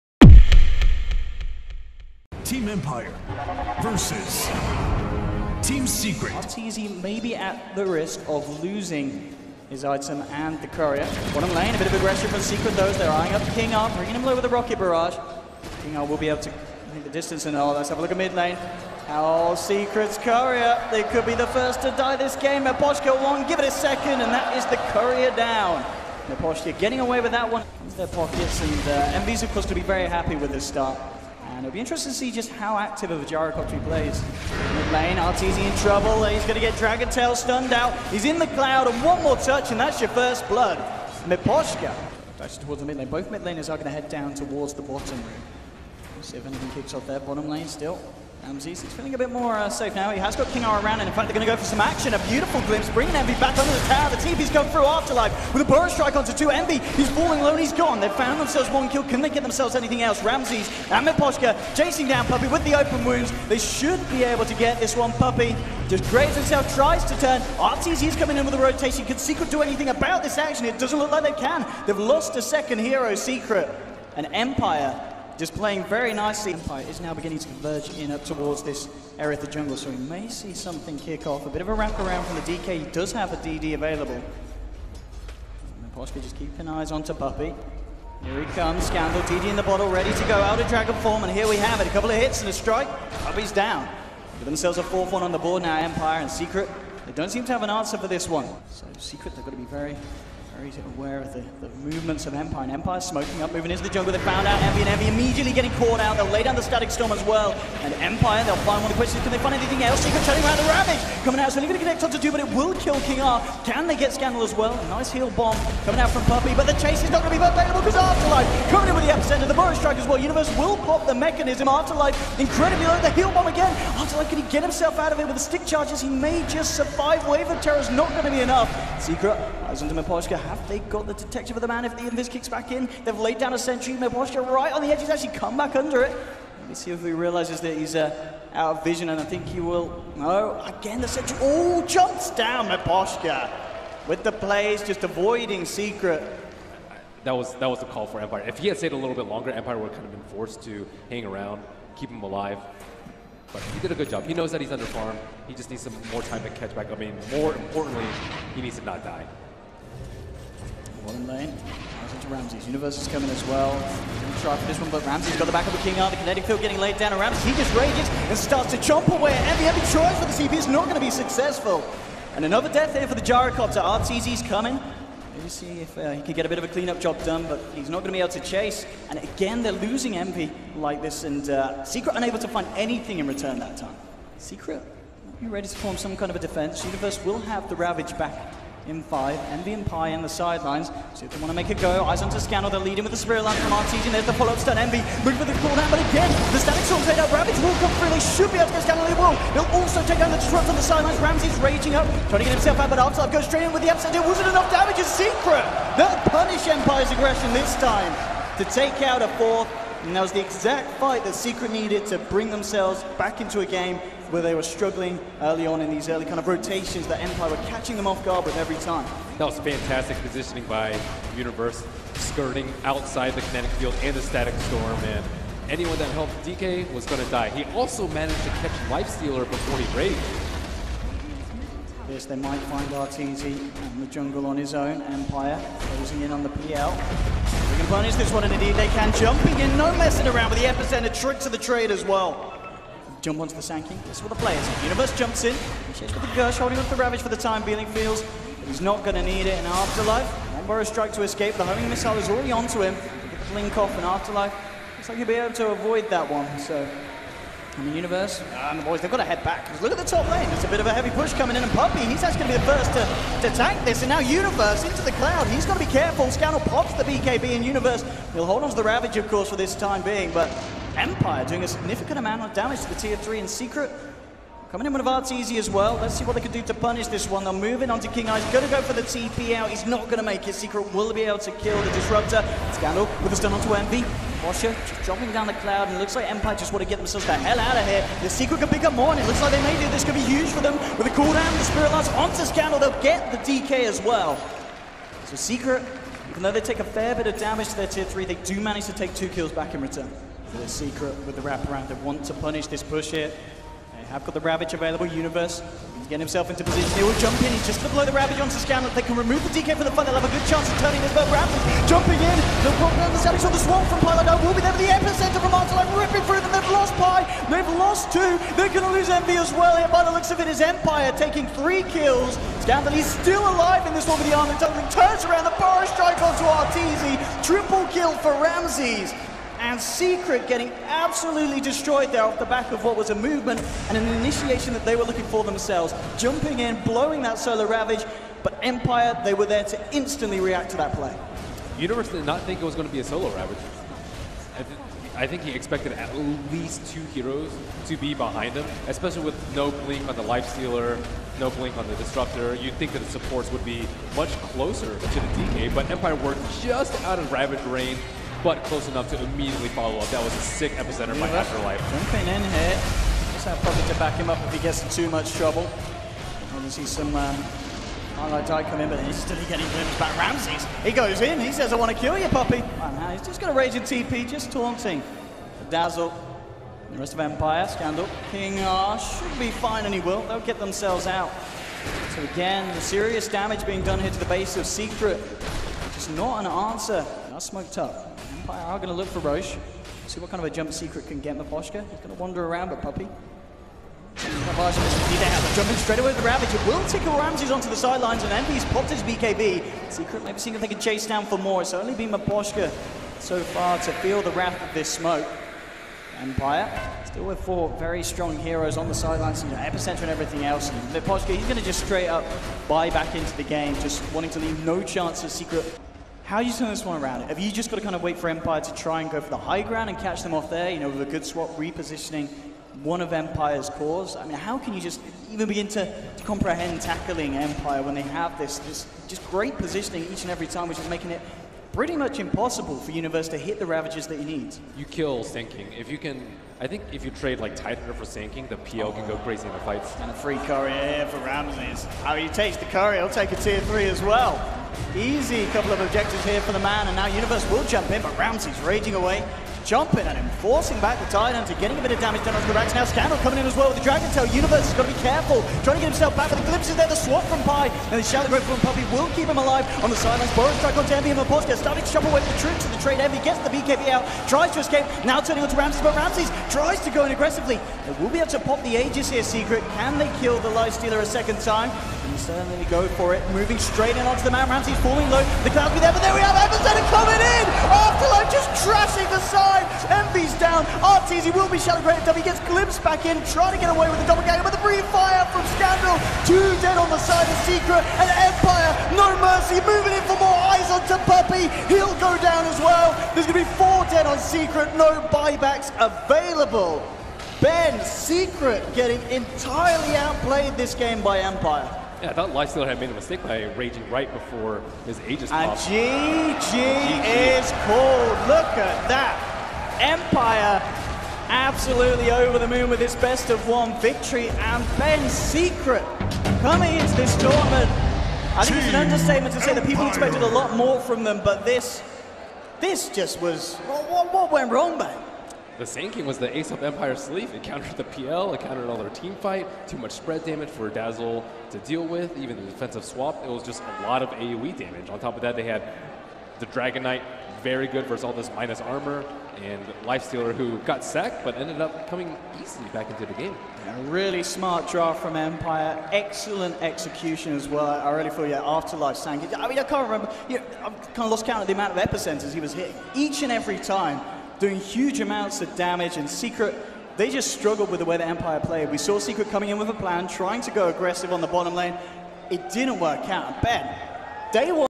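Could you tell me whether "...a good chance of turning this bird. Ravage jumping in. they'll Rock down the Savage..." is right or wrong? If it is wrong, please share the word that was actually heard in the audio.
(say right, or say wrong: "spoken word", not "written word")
right.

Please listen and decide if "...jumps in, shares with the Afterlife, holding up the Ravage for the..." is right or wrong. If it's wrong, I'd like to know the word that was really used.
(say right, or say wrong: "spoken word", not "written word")
wrong: "Gersh", not "Afterlife".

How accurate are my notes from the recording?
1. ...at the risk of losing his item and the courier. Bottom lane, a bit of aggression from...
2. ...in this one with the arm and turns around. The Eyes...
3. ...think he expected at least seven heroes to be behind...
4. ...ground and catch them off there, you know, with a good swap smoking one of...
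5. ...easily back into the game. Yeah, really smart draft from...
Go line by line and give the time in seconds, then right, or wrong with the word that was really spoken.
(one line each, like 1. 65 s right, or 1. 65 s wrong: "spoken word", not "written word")
1. 7 s right
2. 323 s wrong: "Forest", not "Eyes"
3. 345 s wrong: "two", not "seven"
4. 419 s wrong: "repositioning", not "smoking"
5. 542 s right.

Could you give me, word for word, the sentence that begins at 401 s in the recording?
It's only been Miposhka so far to feel the wrath of this smoke.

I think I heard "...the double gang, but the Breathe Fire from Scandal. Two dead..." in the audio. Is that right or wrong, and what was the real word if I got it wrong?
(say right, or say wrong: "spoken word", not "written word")
right.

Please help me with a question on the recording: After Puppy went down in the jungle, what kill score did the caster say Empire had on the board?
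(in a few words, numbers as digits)
4-1.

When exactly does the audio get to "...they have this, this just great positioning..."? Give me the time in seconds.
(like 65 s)
427 s.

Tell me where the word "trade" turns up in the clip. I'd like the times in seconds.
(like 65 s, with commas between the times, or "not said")
241 s, 437 s, 462 s.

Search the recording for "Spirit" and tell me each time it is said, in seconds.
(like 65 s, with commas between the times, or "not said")
193 s, 291 s.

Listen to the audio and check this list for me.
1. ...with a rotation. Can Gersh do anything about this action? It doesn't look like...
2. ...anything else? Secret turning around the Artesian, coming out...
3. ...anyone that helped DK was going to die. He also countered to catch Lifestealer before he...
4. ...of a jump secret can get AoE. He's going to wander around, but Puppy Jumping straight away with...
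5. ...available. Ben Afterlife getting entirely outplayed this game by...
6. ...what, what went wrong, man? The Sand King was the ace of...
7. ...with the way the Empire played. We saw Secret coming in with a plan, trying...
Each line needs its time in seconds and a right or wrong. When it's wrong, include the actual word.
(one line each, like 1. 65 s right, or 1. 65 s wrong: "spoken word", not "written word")
1. 68 s wrong: "Secret", not "Gersh"
2. 109 s wrong: "Ravage", not "Artesian"
3. 225 s wrong: "managed", not "countered"
4. 390 s wrong: "Miposhka", not "AoE"
5. 495 s wrong: "Secret", not "Afterlife"
6. 523 s right
7. 557 s right.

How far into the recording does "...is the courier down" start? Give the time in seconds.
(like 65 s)
24 s.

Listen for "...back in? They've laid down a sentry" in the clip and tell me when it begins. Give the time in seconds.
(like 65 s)
132 s.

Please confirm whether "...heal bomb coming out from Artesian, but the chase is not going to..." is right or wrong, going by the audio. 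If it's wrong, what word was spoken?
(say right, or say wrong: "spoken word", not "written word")
wrong: "Puppy", not "Artesian".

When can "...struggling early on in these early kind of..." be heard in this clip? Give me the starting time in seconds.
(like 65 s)
214 s.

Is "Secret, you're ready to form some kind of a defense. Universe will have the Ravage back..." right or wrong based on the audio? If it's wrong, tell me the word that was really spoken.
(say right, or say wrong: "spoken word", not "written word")
right.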